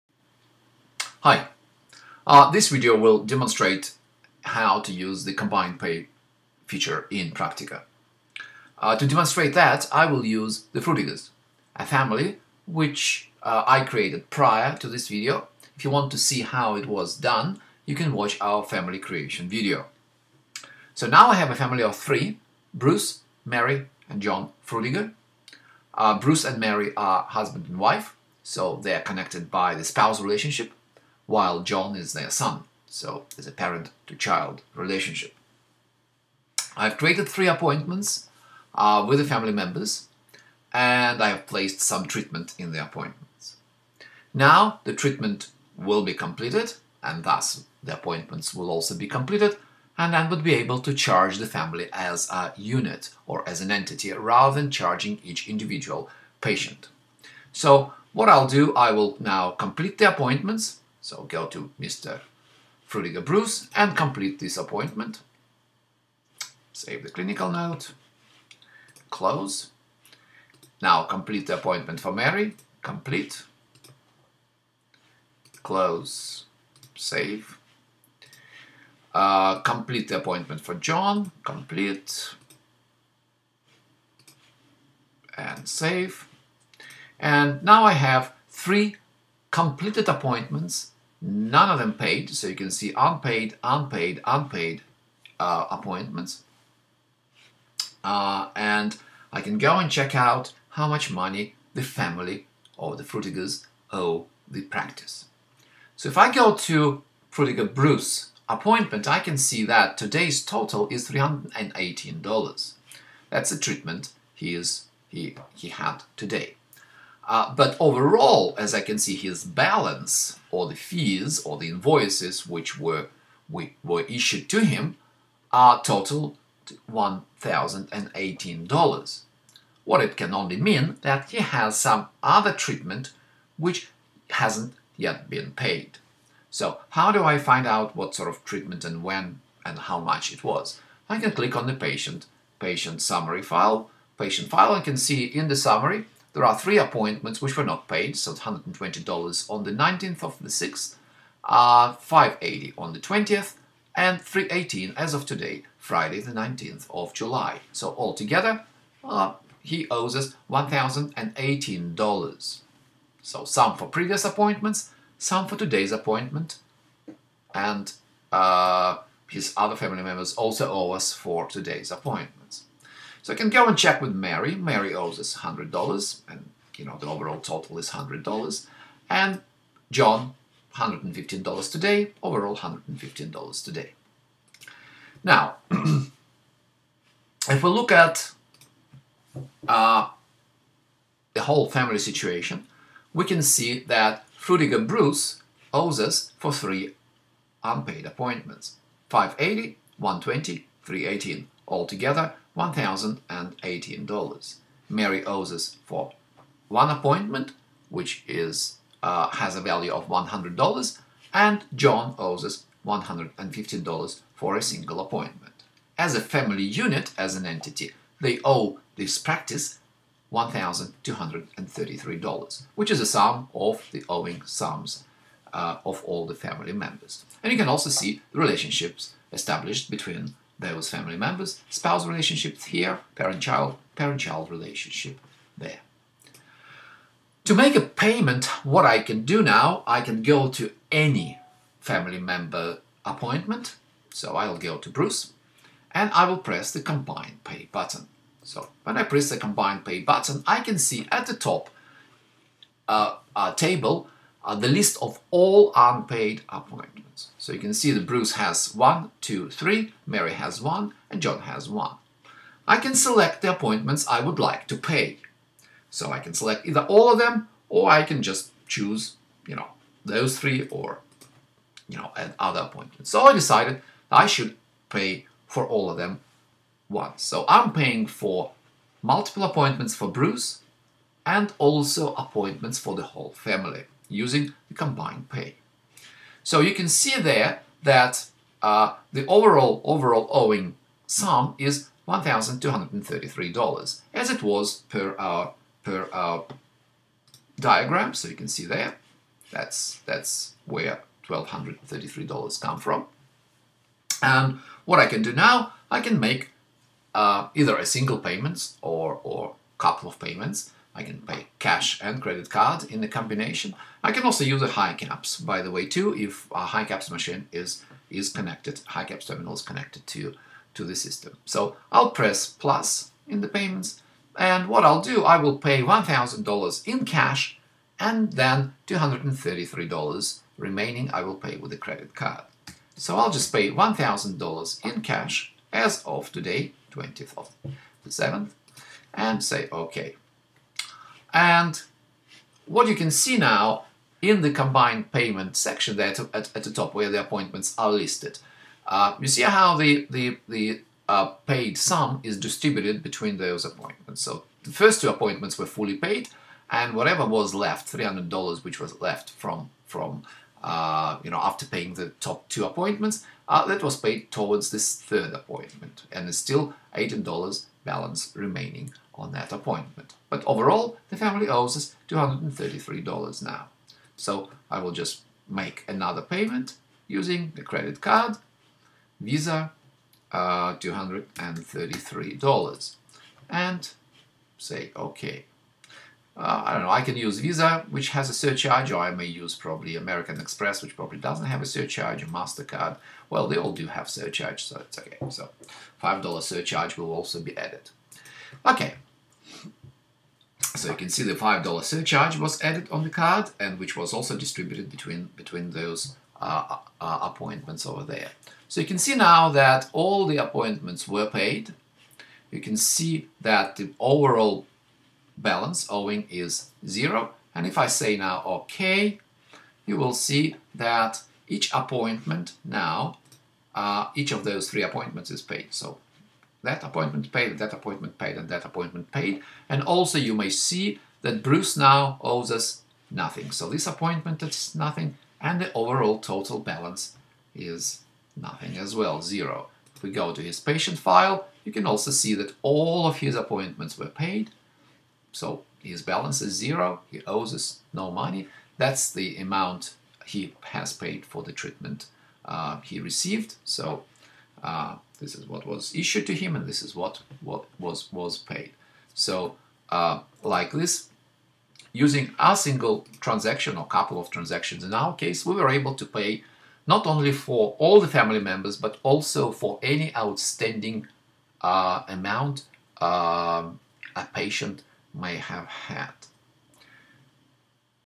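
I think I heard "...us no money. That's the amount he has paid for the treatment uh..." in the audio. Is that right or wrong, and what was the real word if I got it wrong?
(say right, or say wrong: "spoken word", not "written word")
right.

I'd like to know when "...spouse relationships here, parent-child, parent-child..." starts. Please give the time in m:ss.
3:51.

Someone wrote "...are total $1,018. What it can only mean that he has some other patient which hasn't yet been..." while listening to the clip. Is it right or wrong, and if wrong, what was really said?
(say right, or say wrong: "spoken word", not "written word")
wrong: "treatment", not "patient".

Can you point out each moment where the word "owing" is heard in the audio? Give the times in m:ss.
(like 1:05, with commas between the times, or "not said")
3:44, 4:50, 6:55.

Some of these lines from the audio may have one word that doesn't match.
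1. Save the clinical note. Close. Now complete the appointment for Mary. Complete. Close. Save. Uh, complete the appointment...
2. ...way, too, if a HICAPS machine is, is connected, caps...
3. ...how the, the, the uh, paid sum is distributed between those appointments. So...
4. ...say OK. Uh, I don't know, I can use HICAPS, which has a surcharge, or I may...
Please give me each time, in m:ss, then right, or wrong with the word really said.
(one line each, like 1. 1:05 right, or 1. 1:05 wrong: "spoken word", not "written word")
1. 1:06 right
2. 5:15 right
3. 5:49 right
4. 6:24 wrong: "Visa", not "HICAPS".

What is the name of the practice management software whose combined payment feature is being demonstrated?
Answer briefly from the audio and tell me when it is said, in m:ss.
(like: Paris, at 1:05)
Praktika, at 0:07.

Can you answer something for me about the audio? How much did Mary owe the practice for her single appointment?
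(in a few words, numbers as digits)
$100.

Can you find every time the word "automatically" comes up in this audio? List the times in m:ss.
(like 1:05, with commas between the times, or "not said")
not said.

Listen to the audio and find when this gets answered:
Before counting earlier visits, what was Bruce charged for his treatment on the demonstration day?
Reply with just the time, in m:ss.
1:49.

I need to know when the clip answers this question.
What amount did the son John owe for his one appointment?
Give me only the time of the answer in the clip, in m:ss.
2:59.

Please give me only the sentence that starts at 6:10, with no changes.
But overall, the family owes us $233 now.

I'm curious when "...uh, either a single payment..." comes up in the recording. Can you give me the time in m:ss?
5:07.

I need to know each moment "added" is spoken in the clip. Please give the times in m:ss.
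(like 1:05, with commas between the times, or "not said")
6:37, 6:42.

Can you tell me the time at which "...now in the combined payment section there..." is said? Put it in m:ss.
5:43.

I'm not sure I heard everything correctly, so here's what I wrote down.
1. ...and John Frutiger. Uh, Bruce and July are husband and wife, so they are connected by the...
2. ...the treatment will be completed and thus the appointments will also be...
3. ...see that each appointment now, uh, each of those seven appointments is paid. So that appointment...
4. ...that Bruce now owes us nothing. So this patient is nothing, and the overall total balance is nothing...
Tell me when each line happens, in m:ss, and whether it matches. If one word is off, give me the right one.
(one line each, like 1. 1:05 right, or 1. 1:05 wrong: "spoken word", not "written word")
1. 0:24 wrong: "Mary", not "July"
2. 0:44 right
3. 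7:00 wrong: "three", not "seven"
4. 7:11 wrong: "appointment", not "patient".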